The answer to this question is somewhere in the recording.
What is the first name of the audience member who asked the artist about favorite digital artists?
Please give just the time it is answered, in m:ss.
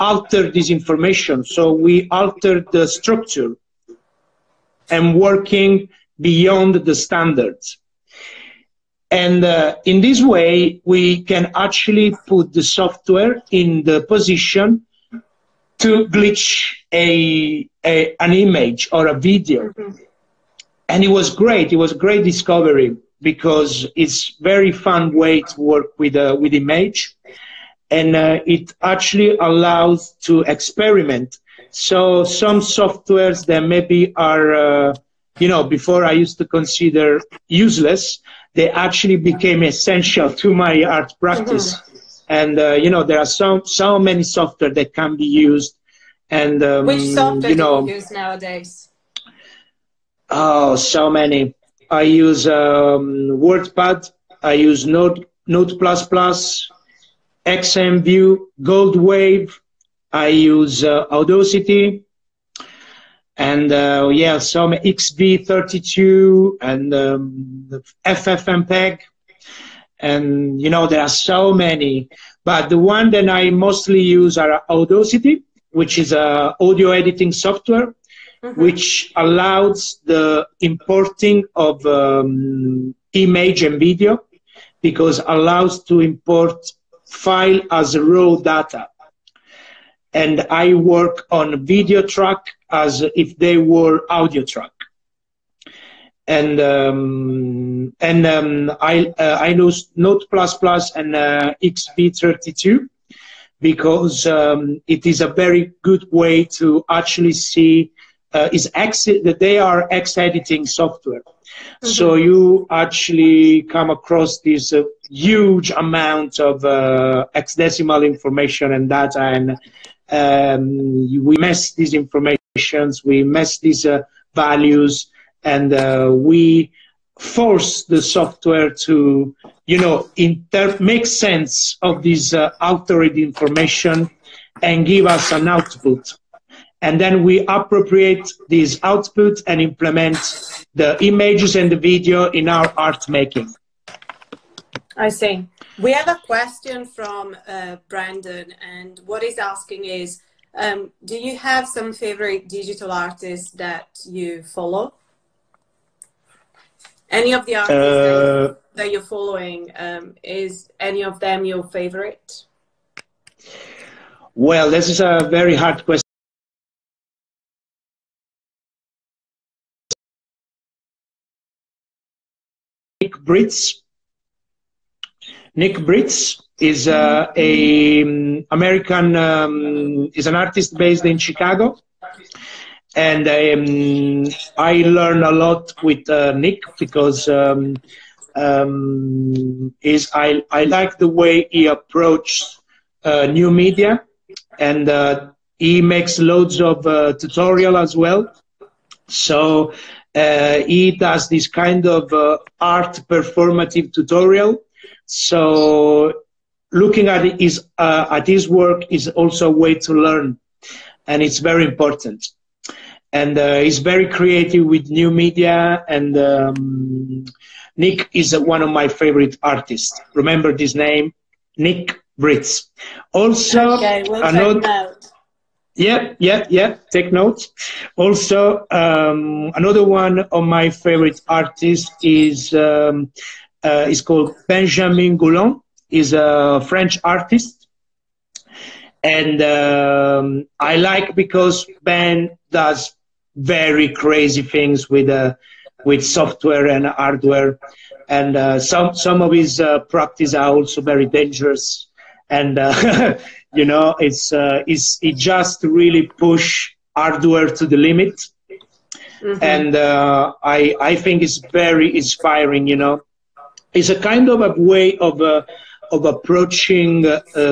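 2:27.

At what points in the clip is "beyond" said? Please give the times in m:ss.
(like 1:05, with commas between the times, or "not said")
0:06.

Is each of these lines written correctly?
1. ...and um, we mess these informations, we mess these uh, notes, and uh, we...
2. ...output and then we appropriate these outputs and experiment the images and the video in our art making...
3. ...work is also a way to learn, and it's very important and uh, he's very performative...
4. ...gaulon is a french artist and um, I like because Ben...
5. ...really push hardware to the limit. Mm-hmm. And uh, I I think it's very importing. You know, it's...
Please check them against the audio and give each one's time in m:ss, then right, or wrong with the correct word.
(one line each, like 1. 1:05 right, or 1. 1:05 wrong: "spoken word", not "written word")
1. 1:59 wrong: "values", not "notes"
2. 2:15 wrong: "implement", not "experiment"
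3. 3:28 wrong: "creative", not "performative"
4. 3:55 right
5. 4:15 wrong: "inspiring", not "importing".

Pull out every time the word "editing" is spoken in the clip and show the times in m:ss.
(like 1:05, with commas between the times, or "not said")
1:16, 1:50.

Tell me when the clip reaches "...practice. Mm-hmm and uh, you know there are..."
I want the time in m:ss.
0:41.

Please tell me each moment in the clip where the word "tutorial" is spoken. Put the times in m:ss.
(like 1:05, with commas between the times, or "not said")
3:17, 3:23.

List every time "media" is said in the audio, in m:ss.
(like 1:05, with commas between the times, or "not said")
3:13, 3:35.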